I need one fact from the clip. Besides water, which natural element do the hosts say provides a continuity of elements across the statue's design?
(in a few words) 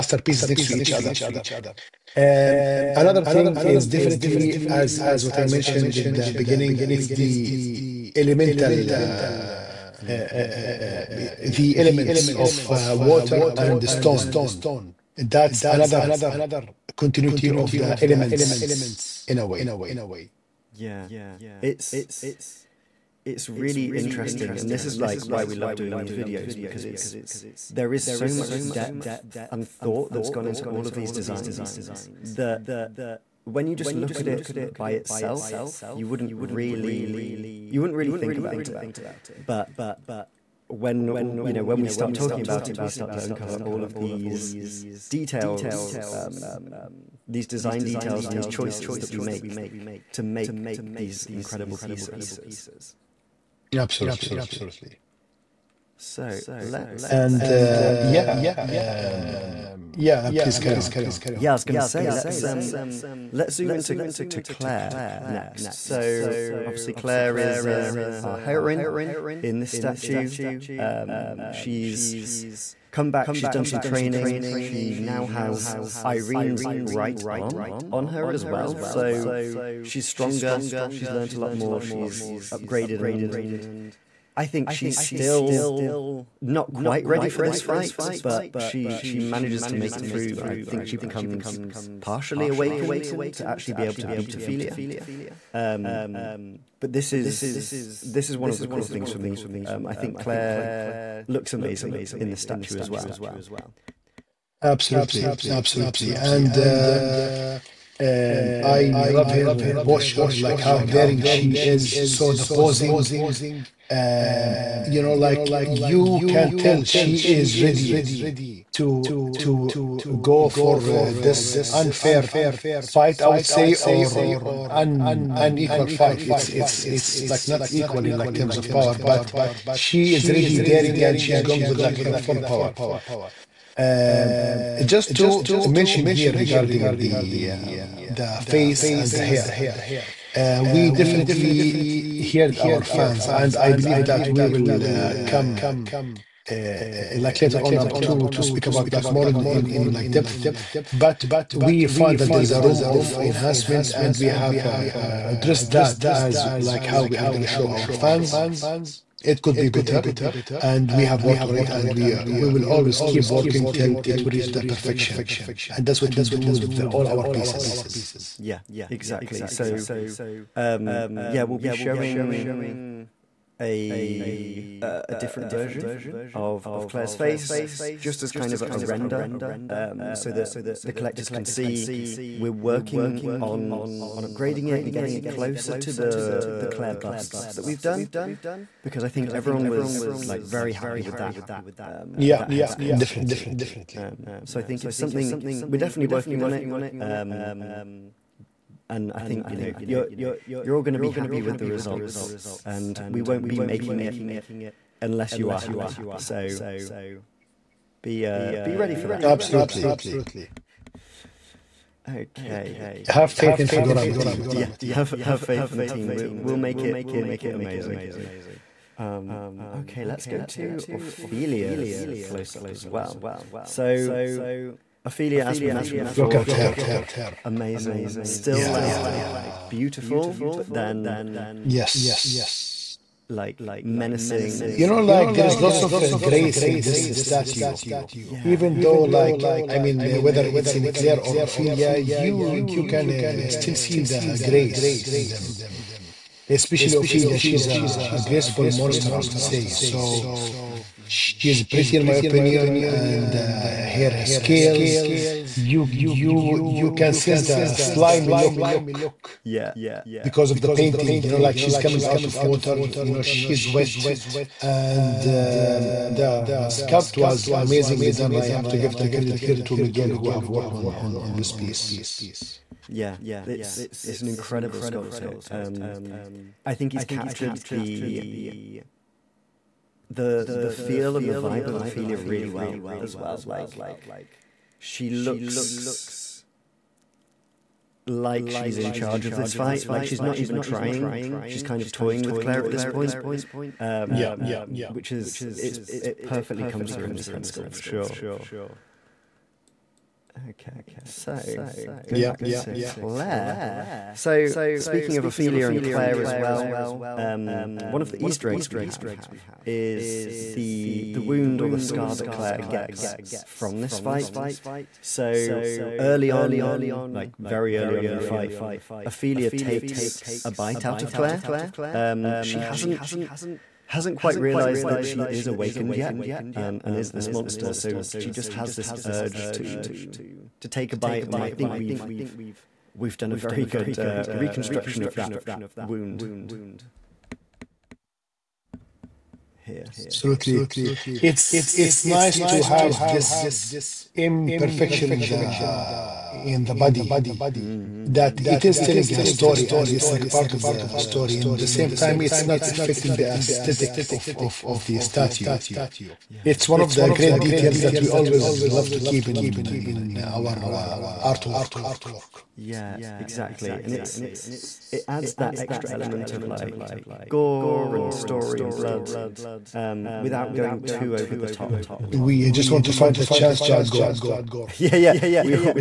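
stone.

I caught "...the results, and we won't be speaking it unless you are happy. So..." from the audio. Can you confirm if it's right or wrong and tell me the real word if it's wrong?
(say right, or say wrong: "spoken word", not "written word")
wrong: "making", not "speaking".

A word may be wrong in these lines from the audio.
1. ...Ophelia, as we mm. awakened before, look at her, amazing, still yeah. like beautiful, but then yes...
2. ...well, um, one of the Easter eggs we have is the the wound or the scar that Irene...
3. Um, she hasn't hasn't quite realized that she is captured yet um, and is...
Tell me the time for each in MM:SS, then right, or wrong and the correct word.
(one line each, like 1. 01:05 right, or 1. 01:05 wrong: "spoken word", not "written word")
1. 03:45 wrong: "mentioned", not "awakened"
2. 05:06 wrong: "Clare", not "Irene"
3. 05:21 wrong: "awakened", not "captured".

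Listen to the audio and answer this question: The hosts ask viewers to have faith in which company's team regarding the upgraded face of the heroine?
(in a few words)
Figurama.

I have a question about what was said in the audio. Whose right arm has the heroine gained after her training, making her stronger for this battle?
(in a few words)
Irene.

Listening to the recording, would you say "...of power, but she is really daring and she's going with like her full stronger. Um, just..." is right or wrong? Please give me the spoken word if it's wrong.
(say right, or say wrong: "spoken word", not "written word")
wrong: "power", not "stronger".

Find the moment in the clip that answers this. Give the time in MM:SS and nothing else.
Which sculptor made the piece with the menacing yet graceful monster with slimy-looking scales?
04:29.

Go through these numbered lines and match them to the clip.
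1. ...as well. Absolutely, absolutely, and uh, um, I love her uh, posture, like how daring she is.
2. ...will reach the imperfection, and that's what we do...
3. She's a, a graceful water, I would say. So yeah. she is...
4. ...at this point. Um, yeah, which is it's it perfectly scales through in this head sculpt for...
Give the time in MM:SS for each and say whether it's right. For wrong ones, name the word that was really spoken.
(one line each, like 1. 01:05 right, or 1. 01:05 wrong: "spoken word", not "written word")
1. 01:42 right
2. 02:44 wrong: "perfection", not "imperfection"
3. 04:07 wrong: "monster", not "water"
4. 04:52 wrong: "comes", not "scales".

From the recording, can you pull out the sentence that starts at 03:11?
Um, yeah, with that head sculpt definitely.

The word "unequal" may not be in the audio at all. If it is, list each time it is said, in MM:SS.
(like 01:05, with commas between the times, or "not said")
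02:05.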